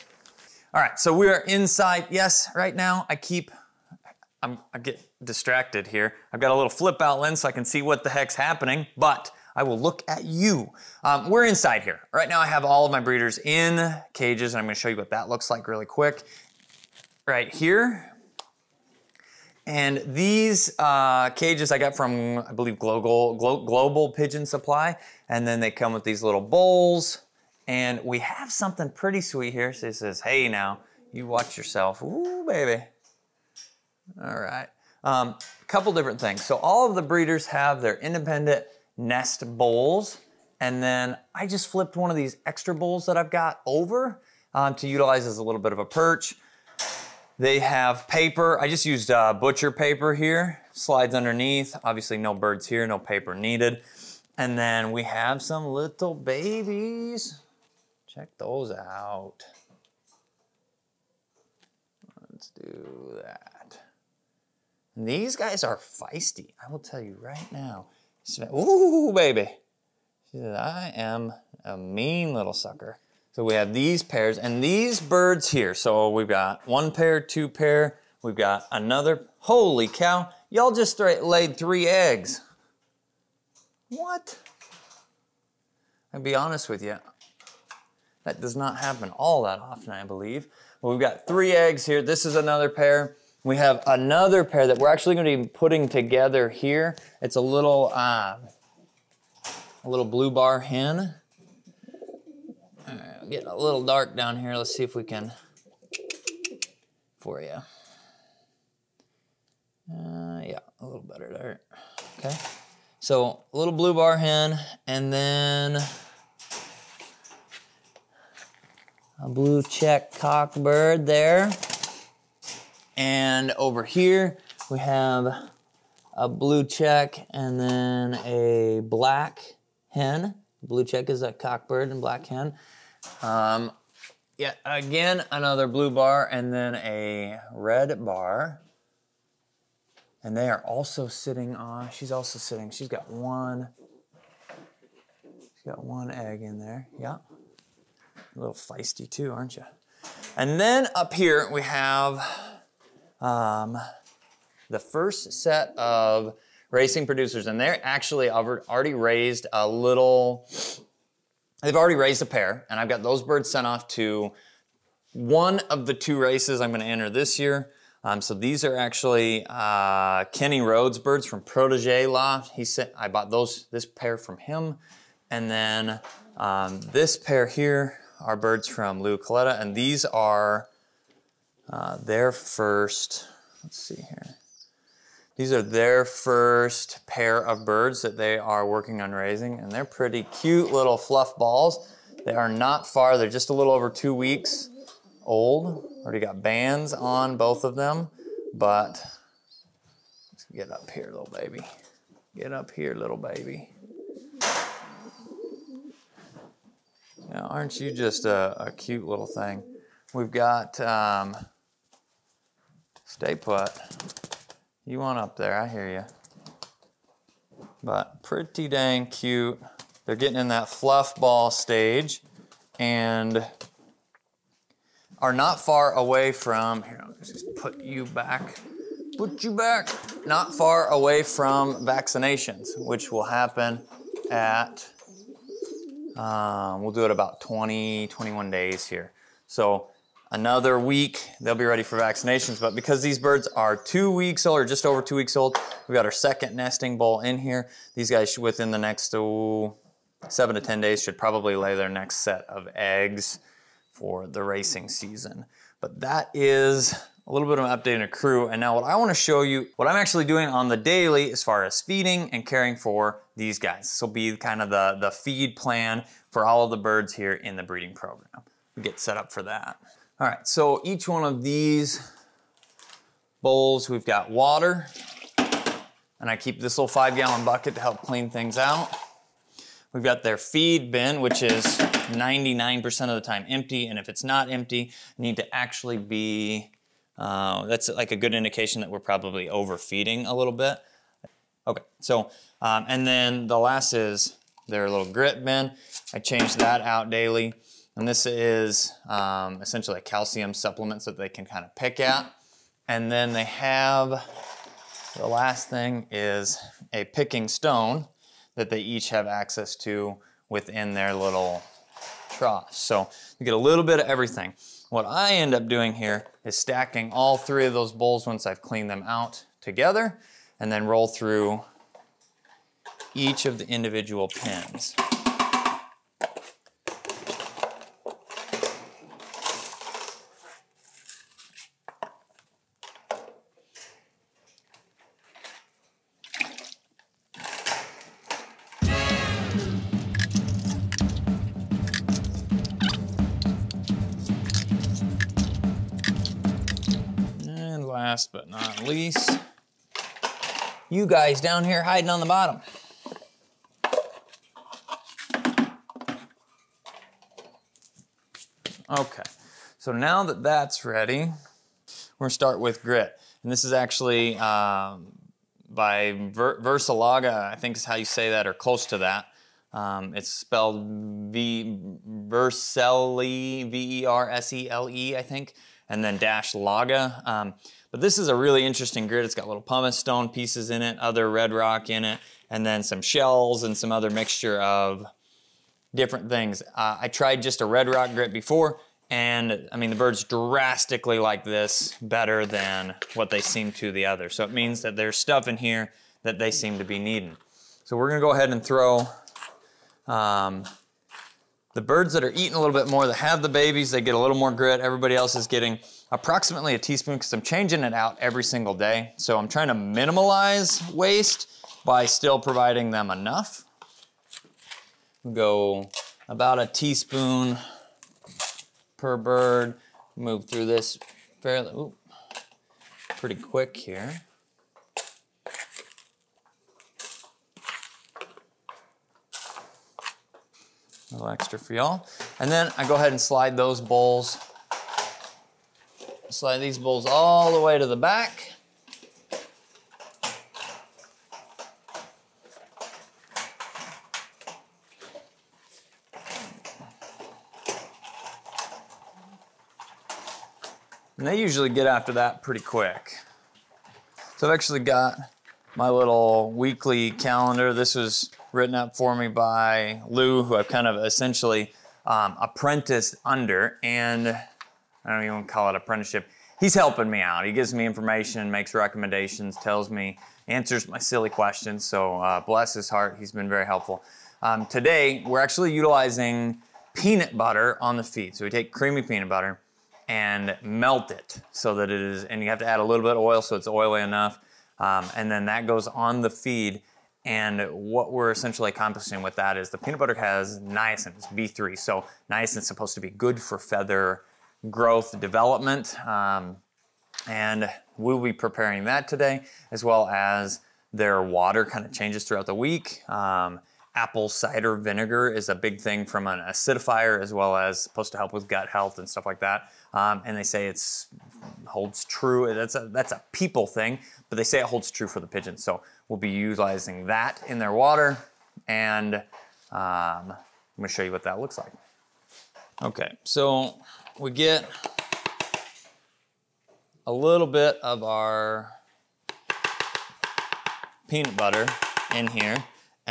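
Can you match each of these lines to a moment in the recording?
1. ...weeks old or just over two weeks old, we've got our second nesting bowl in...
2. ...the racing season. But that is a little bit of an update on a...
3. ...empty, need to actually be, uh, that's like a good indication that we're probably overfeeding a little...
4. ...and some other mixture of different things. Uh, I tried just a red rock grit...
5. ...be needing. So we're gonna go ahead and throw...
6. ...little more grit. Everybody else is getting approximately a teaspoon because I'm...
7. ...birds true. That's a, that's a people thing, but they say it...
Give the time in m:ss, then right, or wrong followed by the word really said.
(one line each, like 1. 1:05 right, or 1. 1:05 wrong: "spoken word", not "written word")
1. 4:04 right
2. 4:14 right
3. 4:44 right
4. 6:23 right
5. 6:36 right
6. 6:44 right
7. 8:31 wrong: "holds", not "birds".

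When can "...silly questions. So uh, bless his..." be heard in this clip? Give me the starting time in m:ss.
7:50.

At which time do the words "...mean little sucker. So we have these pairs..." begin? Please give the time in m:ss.
1:11.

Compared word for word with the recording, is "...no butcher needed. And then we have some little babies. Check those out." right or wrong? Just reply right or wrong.
wrong.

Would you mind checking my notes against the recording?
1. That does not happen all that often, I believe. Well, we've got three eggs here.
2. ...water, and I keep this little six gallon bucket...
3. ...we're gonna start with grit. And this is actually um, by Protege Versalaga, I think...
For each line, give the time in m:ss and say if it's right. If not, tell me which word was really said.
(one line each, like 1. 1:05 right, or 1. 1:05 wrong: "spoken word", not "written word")
1. 1:28 right
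2. 4:34 wrong: "five", not "six"
3. 6:02 wrong: "Ver", not "Protege".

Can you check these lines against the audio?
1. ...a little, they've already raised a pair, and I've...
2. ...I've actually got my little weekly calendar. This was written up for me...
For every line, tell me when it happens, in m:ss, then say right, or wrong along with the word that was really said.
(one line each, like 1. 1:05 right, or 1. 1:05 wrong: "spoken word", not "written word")
1. 2:39 right
2. 7:34 right.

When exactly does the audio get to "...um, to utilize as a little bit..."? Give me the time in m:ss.
0:44.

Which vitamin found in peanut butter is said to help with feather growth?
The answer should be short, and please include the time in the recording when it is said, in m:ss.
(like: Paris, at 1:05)
B3 (niacin), at 8:10.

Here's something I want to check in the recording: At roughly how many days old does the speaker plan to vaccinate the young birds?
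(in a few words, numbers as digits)
20 to 21 days.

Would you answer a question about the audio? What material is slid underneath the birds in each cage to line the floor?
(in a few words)
Butcher paper.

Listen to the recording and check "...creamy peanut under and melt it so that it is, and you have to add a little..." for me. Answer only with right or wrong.
wrong.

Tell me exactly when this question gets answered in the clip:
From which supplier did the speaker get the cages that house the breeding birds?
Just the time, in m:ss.
0:23.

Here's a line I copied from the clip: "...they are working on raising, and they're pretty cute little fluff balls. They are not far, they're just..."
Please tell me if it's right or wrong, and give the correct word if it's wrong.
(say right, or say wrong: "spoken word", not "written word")
right.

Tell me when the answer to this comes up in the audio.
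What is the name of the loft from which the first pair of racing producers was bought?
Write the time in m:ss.
2:51.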